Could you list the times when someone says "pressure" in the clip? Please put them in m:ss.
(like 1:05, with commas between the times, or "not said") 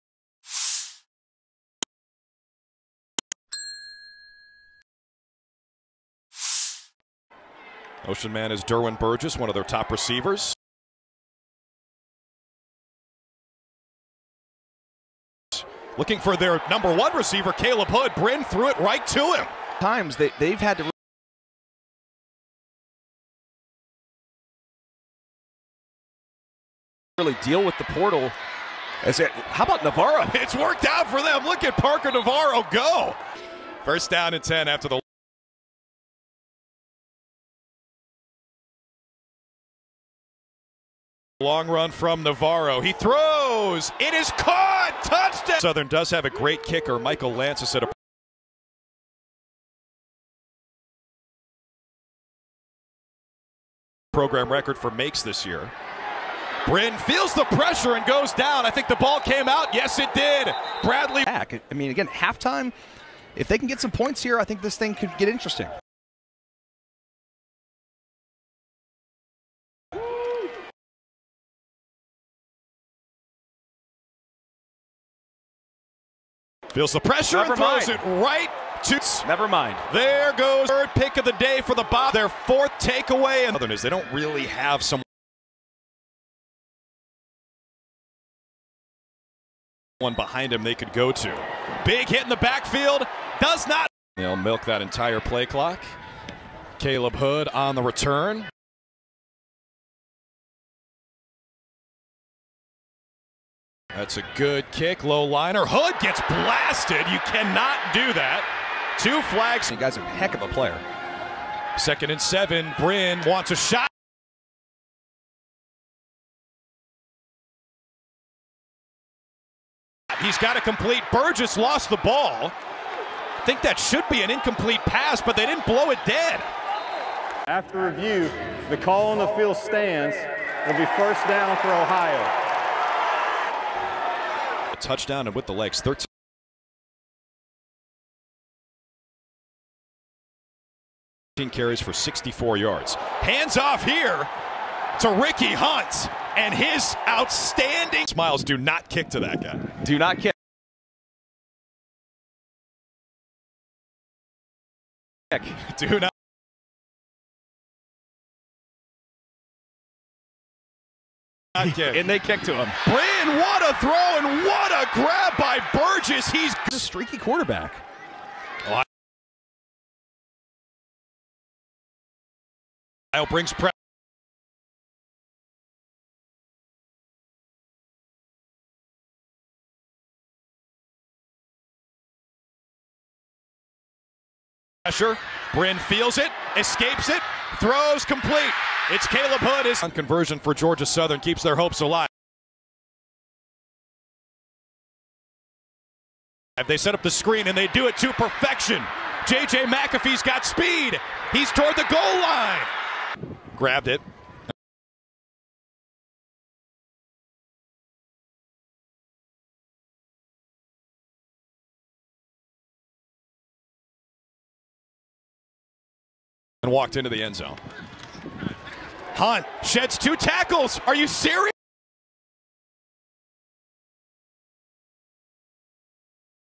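0:57, 1:16, 2:53, 3:04.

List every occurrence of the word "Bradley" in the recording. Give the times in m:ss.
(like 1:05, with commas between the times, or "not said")
1:00.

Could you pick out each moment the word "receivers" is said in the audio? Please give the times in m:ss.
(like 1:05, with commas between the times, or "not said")
0:09, 0:17.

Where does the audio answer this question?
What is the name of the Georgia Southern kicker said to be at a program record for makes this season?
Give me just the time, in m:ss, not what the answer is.
0:46.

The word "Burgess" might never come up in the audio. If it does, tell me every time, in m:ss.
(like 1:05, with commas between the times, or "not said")
0:08, 2:01, 2:45.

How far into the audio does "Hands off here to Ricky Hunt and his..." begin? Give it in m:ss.
2:22.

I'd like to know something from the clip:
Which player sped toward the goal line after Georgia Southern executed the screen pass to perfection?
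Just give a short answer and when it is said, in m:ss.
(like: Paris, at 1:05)
J.J. McAfee, at 3:19.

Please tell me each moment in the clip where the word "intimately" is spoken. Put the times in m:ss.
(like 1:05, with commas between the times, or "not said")
not said.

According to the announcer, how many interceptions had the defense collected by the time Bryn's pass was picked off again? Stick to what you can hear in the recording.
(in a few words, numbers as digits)
3.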